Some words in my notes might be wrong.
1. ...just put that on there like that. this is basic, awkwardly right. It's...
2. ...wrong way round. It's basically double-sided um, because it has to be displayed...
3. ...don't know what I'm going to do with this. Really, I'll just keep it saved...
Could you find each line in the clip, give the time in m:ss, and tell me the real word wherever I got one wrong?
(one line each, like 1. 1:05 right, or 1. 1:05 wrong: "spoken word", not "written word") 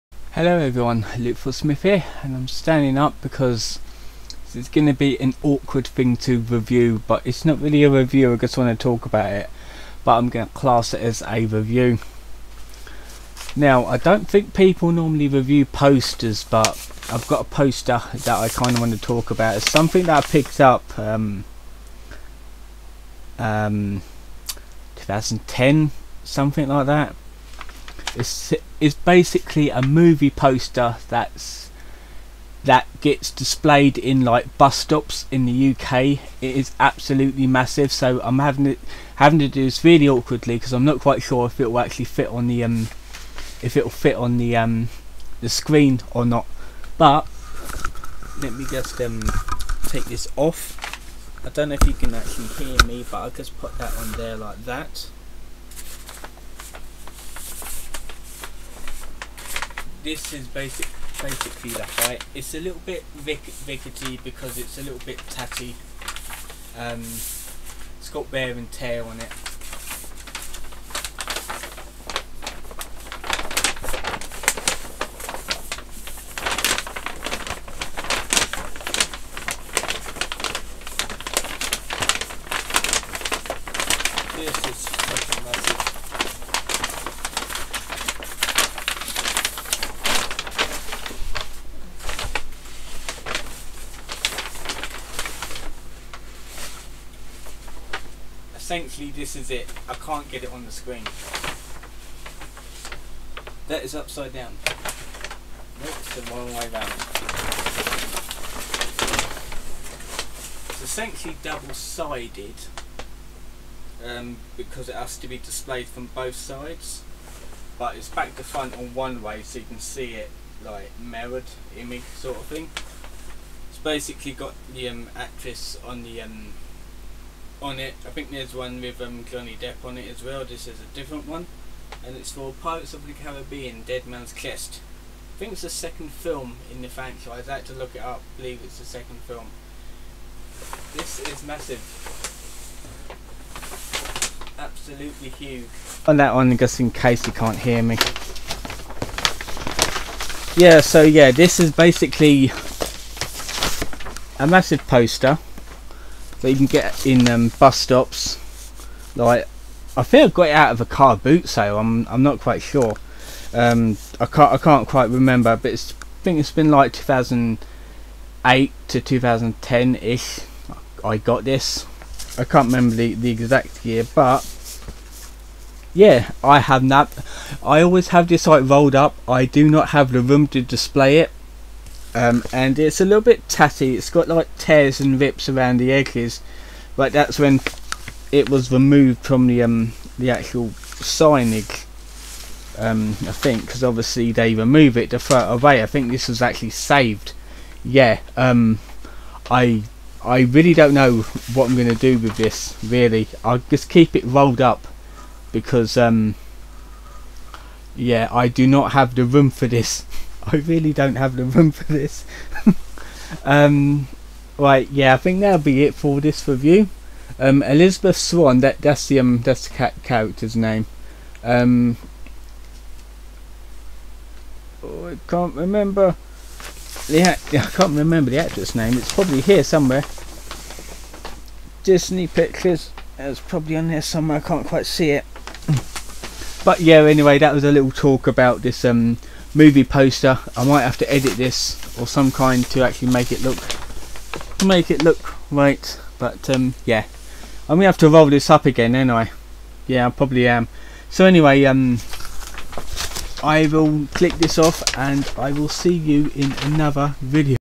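1. 0:53 wrong: "basically", not "awkwardly"
2. 1:46 wrong: "essentially", not "basically"
3. 3:20 wrong: "rolled", not "saved".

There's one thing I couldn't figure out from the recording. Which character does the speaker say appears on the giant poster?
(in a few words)
Elizabeth Swann.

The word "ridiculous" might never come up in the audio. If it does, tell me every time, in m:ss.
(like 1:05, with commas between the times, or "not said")
not said.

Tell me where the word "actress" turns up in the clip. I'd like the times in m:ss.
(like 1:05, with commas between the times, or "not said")
2:05, 3:48.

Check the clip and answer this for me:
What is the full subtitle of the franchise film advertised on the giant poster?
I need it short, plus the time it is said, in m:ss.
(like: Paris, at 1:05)
Dead Man's Chest, at 2:13.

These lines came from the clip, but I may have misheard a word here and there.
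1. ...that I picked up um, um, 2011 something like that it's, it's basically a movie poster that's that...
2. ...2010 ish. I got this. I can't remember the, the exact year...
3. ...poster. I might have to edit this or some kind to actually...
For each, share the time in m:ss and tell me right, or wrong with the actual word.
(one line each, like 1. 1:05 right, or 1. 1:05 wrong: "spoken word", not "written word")
1. 0:20 wrong: "2010", not "2011"
2. 2:49 right
3. 3:59 right.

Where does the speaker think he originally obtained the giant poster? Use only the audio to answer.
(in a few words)
a car boot sale.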